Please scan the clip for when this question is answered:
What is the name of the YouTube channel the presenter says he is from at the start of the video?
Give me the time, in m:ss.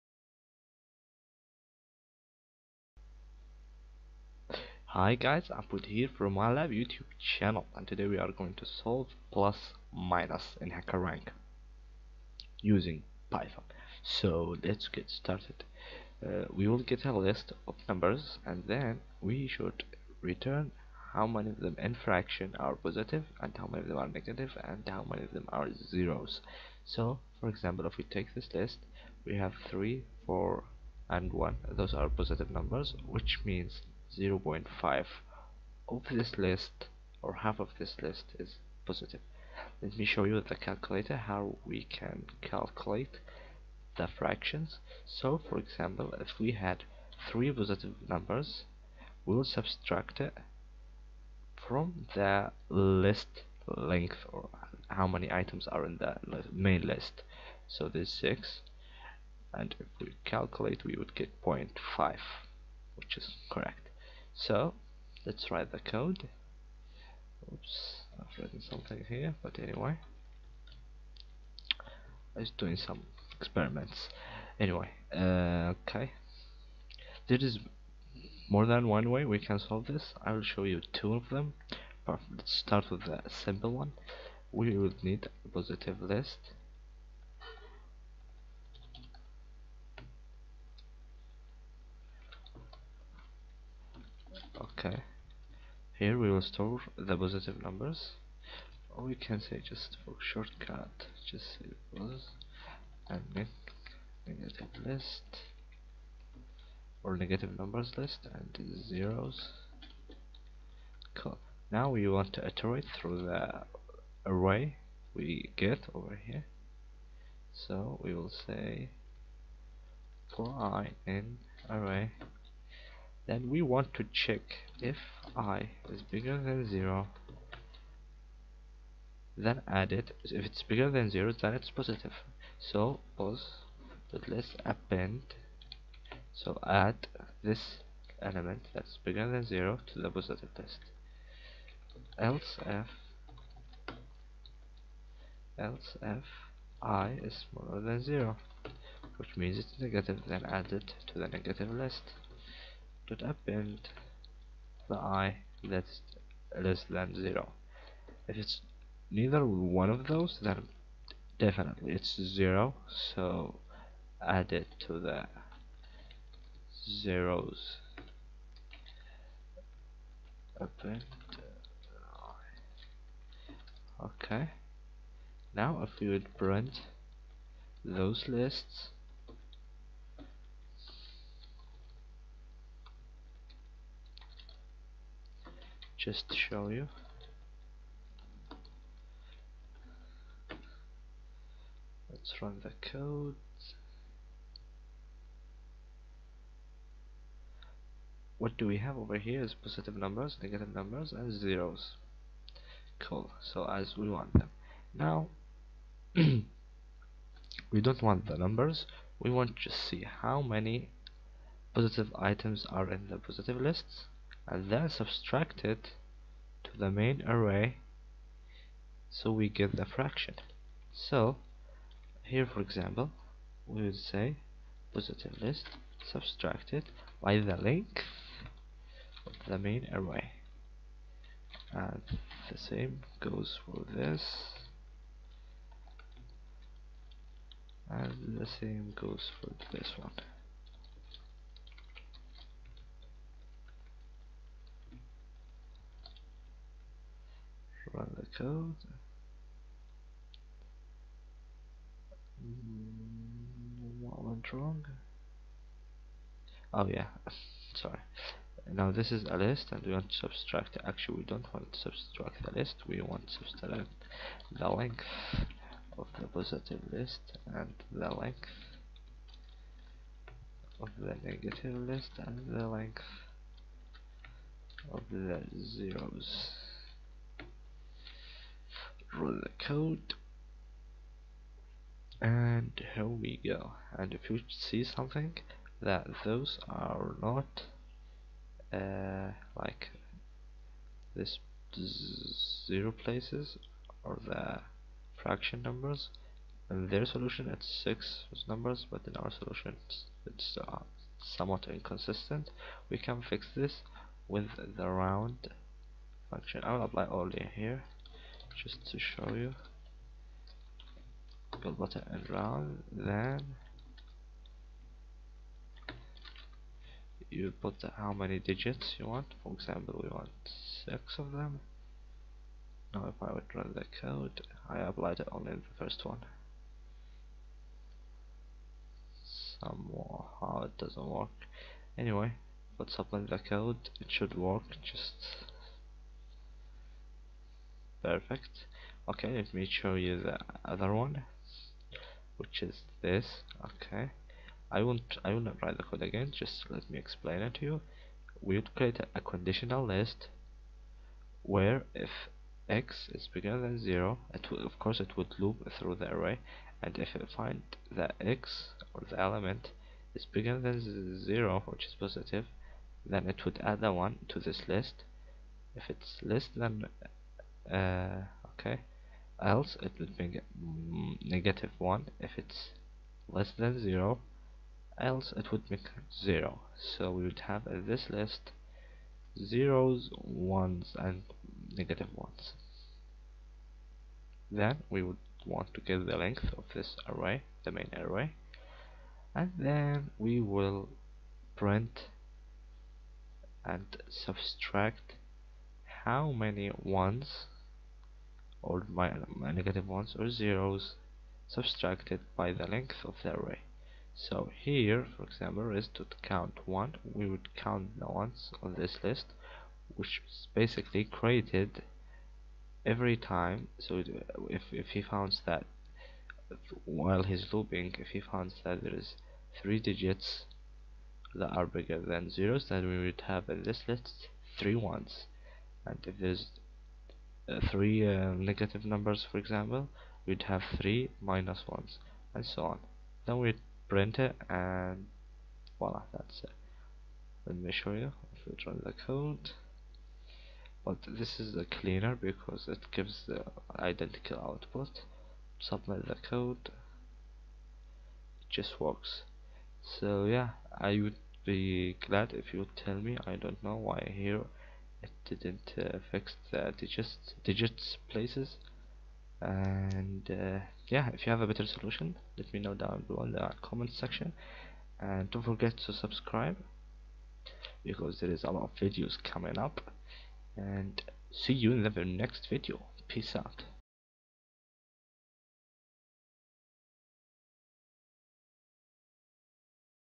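0:06.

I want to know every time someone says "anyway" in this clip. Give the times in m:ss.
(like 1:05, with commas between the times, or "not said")
1:09, 1:14, 5:31.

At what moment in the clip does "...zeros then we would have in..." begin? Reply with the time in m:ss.
7:02.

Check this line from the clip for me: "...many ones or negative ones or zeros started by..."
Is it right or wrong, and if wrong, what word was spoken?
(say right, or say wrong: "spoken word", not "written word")
wrong: "subtracted", not "started".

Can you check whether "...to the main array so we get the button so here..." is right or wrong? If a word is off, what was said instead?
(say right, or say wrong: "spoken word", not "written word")
wrong: "fraction", not "button".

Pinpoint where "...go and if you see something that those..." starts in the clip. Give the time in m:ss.
4:43.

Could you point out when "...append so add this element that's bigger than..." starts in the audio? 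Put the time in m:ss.
2:14.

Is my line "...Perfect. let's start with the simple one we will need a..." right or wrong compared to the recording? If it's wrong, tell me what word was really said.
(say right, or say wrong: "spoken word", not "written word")
right.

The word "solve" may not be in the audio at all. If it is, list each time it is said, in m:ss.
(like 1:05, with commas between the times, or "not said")
0:08, 1:19.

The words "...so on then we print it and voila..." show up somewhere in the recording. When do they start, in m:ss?
7:12.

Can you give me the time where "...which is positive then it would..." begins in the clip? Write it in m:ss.
6:01.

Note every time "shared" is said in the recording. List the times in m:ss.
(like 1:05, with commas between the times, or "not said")
not said.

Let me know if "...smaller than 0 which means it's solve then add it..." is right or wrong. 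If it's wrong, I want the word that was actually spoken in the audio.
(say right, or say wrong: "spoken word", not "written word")
wrong: "negative", not "solve".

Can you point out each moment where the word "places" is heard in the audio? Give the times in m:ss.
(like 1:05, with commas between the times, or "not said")
4:52, 7:38.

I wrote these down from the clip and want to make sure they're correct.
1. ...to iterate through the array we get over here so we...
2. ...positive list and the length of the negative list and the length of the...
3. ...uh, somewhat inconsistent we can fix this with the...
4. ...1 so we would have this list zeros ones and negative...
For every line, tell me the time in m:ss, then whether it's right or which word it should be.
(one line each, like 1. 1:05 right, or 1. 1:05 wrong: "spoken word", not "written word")
1. 1:52 right
2. 4:26 right
3. 5:00 right
4. 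6:16 wrong: "0", not "1".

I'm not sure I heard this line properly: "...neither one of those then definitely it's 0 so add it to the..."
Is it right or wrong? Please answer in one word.
right.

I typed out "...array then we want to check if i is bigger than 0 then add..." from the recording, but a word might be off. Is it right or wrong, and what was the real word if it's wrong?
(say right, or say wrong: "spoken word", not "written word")
right.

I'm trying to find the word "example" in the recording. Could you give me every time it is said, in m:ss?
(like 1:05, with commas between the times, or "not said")
0:27, 0:45, 3:42, 5:19, 6:45, 7:09.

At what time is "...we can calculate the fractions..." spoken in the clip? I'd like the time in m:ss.
0:41.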